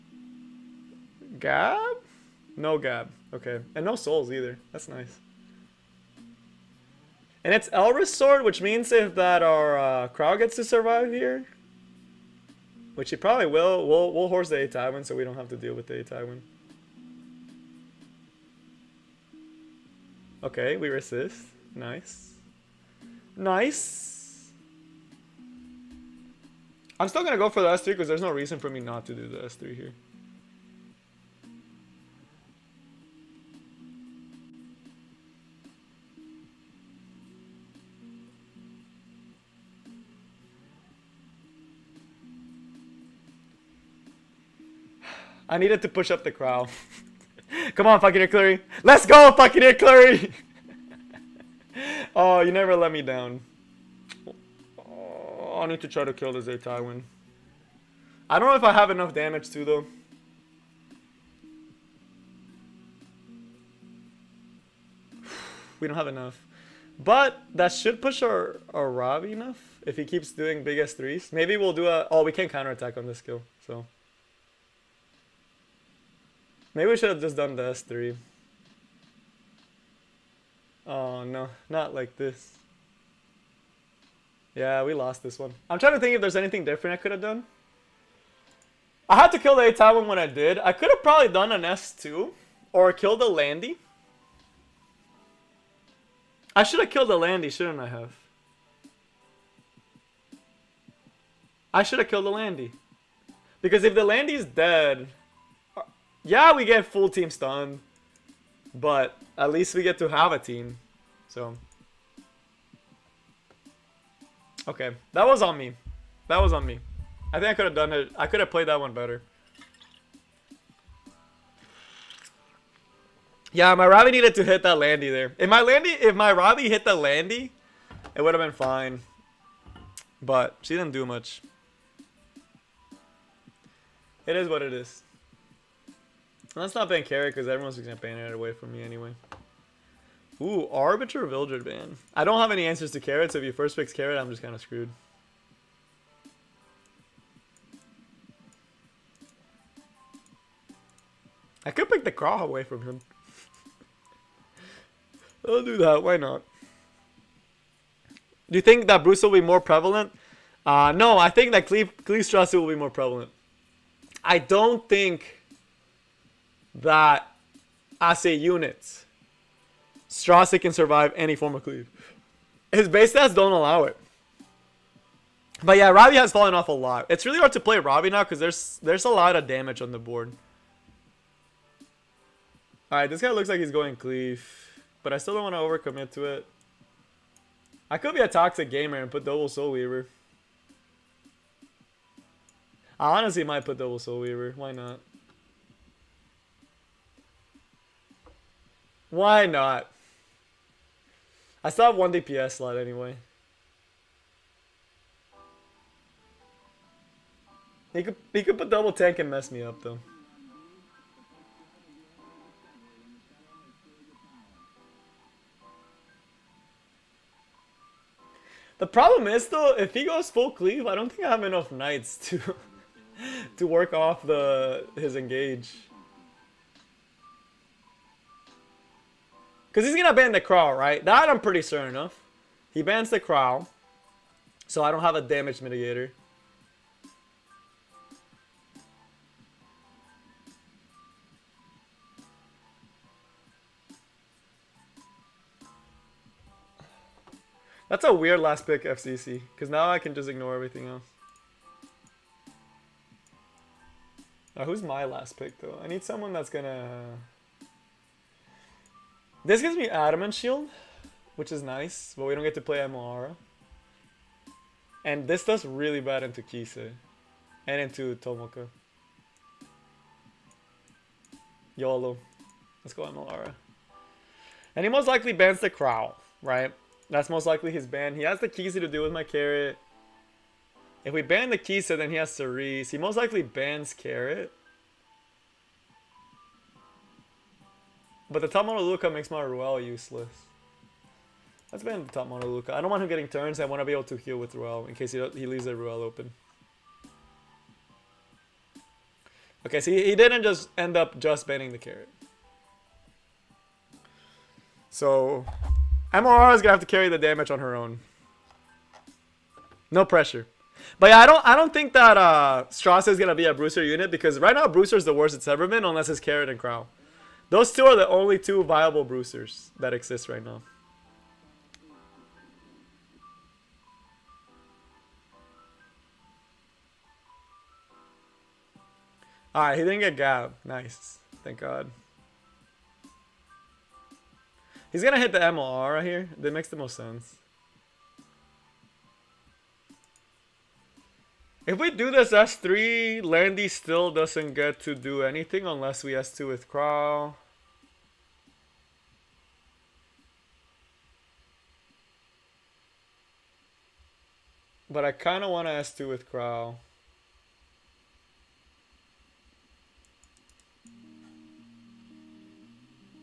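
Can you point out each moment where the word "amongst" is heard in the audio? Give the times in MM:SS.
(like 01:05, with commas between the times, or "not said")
not said.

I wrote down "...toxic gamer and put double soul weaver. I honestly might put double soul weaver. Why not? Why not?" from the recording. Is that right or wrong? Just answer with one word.
right.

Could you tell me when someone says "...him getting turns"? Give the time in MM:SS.
04:53.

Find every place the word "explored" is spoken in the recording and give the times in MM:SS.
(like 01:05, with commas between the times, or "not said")
not said.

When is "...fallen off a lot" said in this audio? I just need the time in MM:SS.
02:56.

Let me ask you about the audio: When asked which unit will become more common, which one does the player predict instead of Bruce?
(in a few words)
Kleestrasse.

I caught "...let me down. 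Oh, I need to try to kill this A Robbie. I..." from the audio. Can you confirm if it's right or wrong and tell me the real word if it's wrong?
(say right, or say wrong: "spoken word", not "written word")
wrong: "Tywin", not "Robbie".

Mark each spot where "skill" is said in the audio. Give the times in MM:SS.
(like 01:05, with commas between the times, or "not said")
01:13.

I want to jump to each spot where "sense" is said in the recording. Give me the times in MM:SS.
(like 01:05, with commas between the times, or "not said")
05:36.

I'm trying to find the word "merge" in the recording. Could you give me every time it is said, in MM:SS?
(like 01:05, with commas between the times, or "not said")
not said.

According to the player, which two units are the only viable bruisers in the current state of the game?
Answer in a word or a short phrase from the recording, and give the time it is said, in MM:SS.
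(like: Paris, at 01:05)
Carrot and Krau, at 05:15.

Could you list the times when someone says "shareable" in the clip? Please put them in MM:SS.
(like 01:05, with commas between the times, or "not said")
not said.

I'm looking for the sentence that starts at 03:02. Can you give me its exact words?
Alright, this guy looks like he's going cleave.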